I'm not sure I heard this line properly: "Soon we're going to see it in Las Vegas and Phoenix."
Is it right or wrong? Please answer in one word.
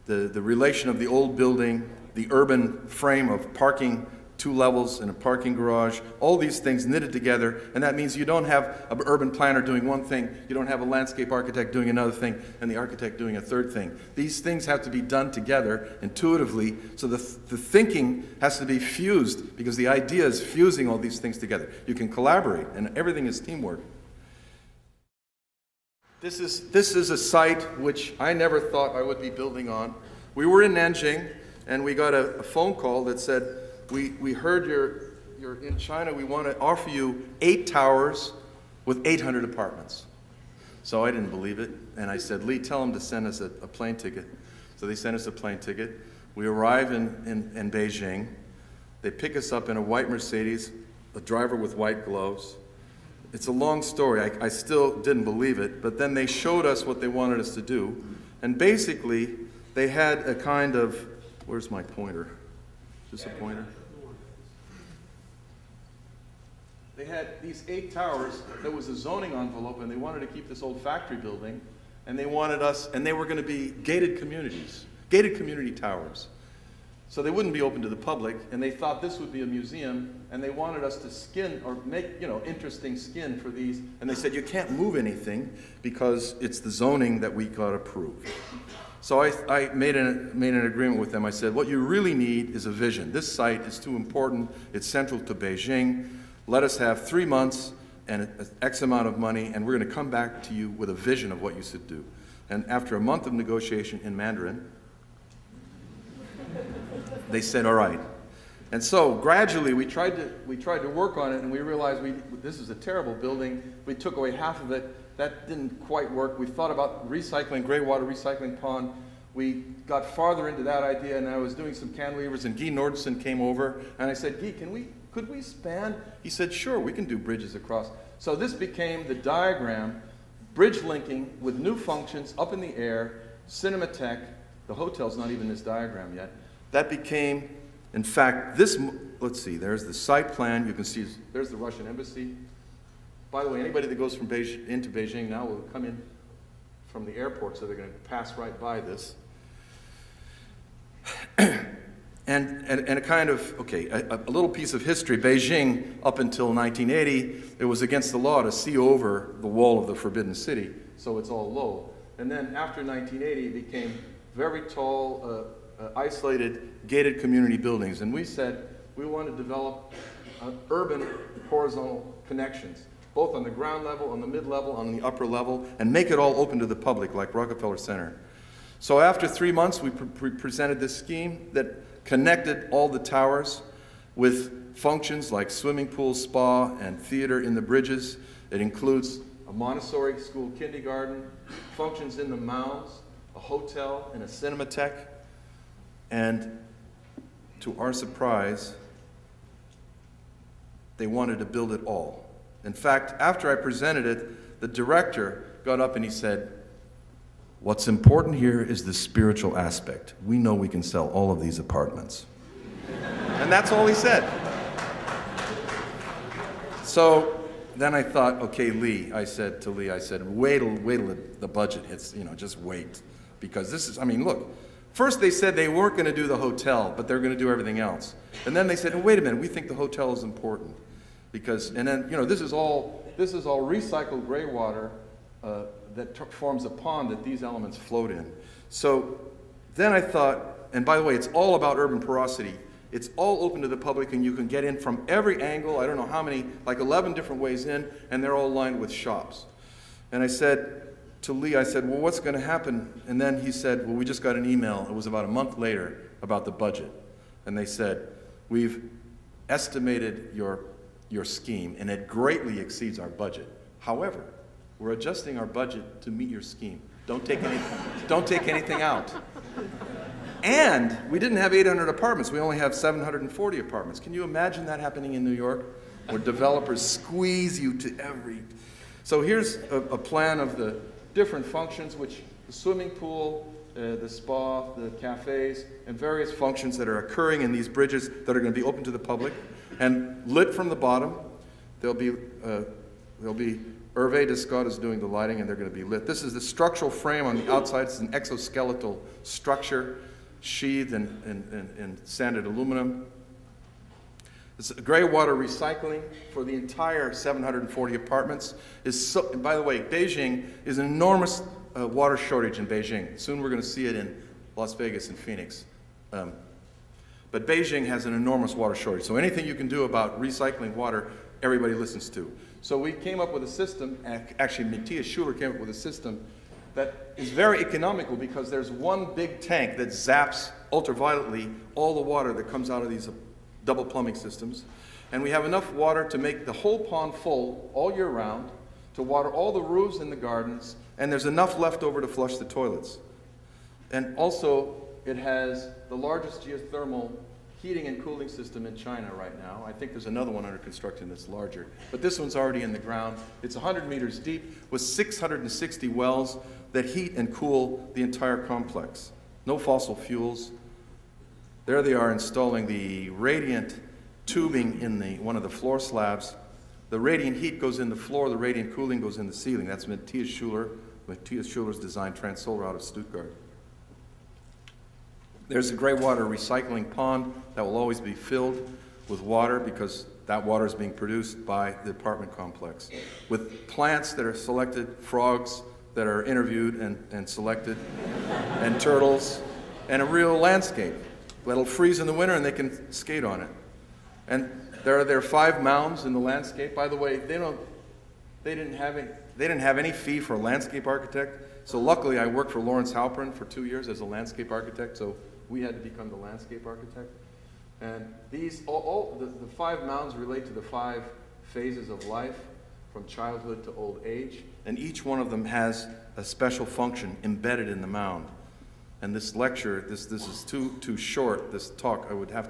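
right.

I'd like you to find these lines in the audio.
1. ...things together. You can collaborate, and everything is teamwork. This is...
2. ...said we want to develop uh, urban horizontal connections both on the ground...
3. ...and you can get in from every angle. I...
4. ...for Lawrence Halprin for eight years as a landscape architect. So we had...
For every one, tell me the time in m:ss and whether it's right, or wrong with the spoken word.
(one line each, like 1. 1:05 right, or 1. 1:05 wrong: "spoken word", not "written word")
1. 0:21 right
2. 2:48 right
3. 4:04 right
4. 6:42 wrong: "two", not "eight".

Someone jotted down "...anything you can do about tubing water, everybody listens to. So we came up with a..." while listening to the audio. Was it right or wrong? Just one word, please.
wrong.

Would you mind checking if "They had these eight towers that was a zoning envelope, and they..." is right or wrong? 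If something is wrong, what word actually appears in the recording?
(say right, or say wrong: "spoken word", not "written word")
right.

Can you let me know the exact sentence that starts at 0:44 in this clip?
So they sent us a plane ticket.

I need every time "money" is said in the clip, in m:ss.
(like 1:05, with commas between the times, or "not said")
1:39.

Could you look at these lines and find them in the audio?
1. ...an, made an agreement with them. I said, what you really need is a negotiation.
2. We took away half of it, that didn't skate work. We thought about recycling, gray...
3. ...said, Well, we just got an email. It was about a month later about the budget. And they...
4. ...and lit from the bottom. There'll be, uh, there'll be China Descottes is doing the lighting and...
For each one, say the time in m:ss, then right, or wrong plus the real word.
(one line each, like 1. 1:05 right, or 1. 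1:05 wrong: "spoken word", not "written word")
1. 1:29 wrong: "vision", not "negotiation"
2. 1:53 wrong: "quite", not "skate"
3. 4:13 right
4. 4:49 wrong: "Hervé", not "China".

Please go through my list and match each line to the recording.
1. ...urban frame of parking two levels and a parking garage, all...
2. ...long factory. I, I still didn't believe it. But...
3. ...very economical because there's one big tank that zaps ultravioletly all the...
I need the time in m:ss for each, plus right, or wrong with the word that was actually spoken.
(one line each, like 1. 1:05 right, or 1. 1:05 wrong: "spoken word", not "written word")
1. 0:02 right
2. 0:53 wrong: "story", not "factory"
3. 5:27 right.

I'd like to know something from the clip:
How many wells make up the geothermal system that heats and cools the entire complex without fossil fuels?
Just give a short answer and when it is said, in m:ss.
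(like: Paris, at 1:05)
660, at 5:54.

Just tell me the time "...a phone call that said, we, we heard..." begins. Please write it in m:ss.
0:32.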